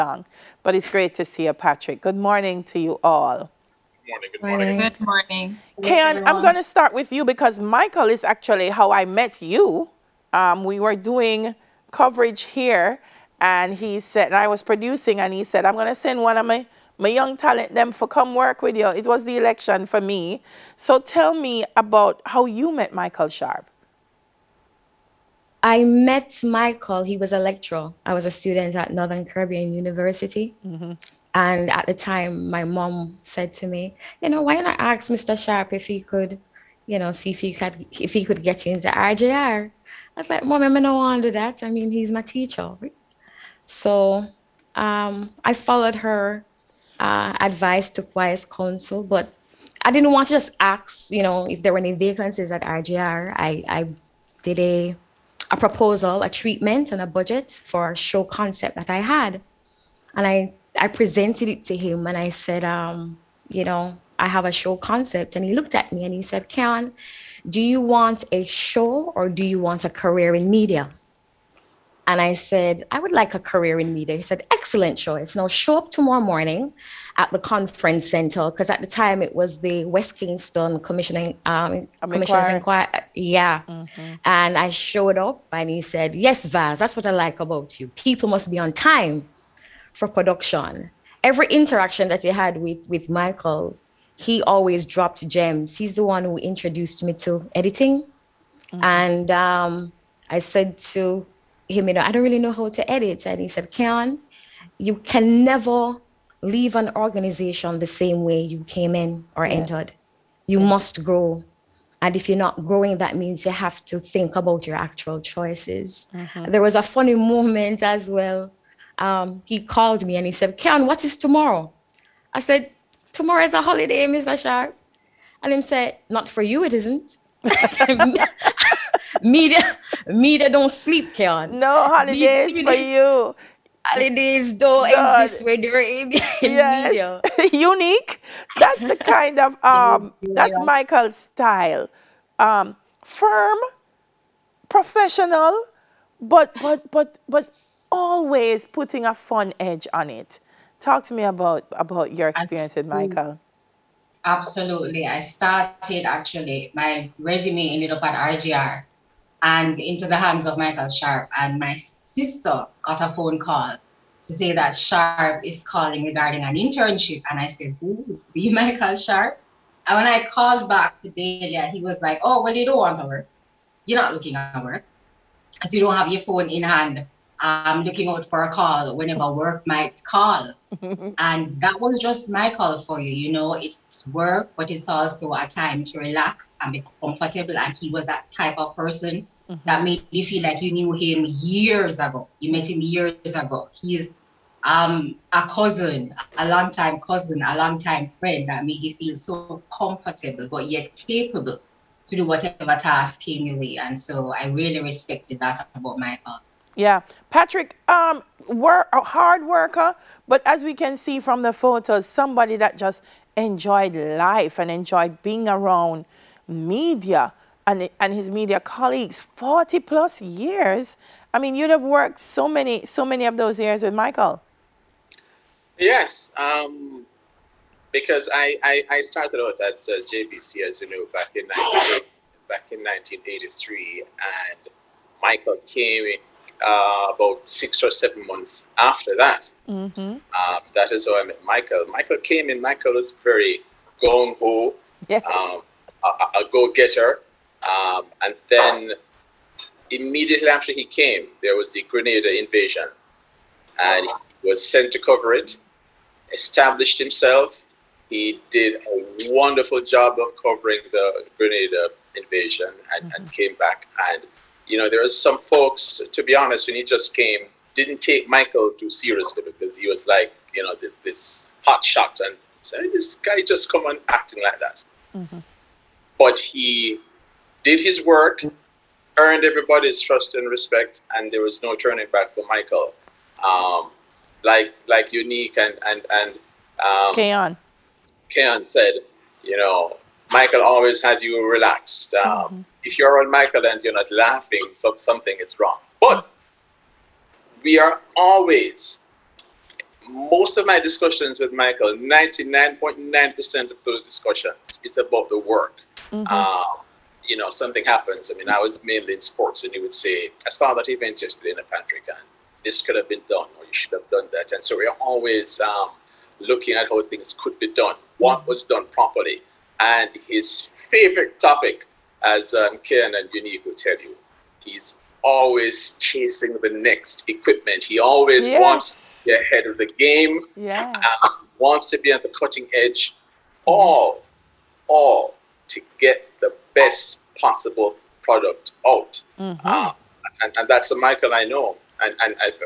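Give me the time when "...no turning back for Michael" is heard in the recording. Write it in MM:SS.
04:41.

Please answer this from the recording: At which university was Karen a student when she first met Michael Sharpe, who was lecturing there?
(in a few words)
Northern Caribbean University.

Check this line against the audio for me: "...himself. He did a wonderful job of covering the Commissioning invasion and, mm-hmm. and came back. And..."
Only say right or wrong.
wrong.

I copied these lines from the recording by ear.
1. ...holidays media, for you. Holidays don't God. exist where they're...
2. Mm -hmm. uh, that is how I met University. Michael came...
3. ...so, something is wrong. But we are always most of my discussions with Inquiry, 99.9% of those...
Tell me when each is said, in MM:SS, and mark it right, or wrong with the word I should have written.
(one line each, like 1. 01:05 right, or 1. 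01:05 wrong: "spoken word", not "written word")
1. 02:11 right
2. 03:59 wrong: "Michael", not "University"
3. 04:54 wrong: "Michael", not "Inquiry".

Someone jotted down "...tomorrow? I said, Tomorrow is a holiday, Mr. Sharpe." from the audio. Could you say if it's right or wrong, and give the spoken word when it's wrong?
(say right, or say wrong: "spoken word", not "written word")
right.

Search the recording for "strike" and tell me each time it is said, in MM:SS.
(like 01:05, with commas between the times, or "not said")
not said.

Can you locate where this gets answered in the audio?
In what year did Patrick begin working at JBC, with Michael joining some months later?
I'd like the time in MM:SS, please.
03:52.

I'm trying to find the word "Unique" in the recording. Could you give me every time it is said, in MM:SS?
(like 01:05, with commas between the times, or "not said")
02:17, 04:45, 05:23.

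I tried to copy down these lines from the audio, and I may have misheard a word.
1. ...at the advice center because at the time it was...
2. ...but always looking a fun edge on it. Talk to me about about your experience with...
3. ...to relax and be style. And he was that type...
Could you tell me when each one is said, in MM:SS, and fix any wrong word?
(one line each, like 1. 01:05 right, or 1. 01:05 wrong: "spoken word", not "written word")
1. 01:17 wrong: "conference", not "advice"
2. 02:27 wrong: "putting", not "looking"
3. 03:05 wrong: "comfortable", not "style".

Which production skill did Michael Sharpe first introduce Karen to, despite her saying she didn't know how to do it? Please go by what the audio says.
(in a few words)
Editing.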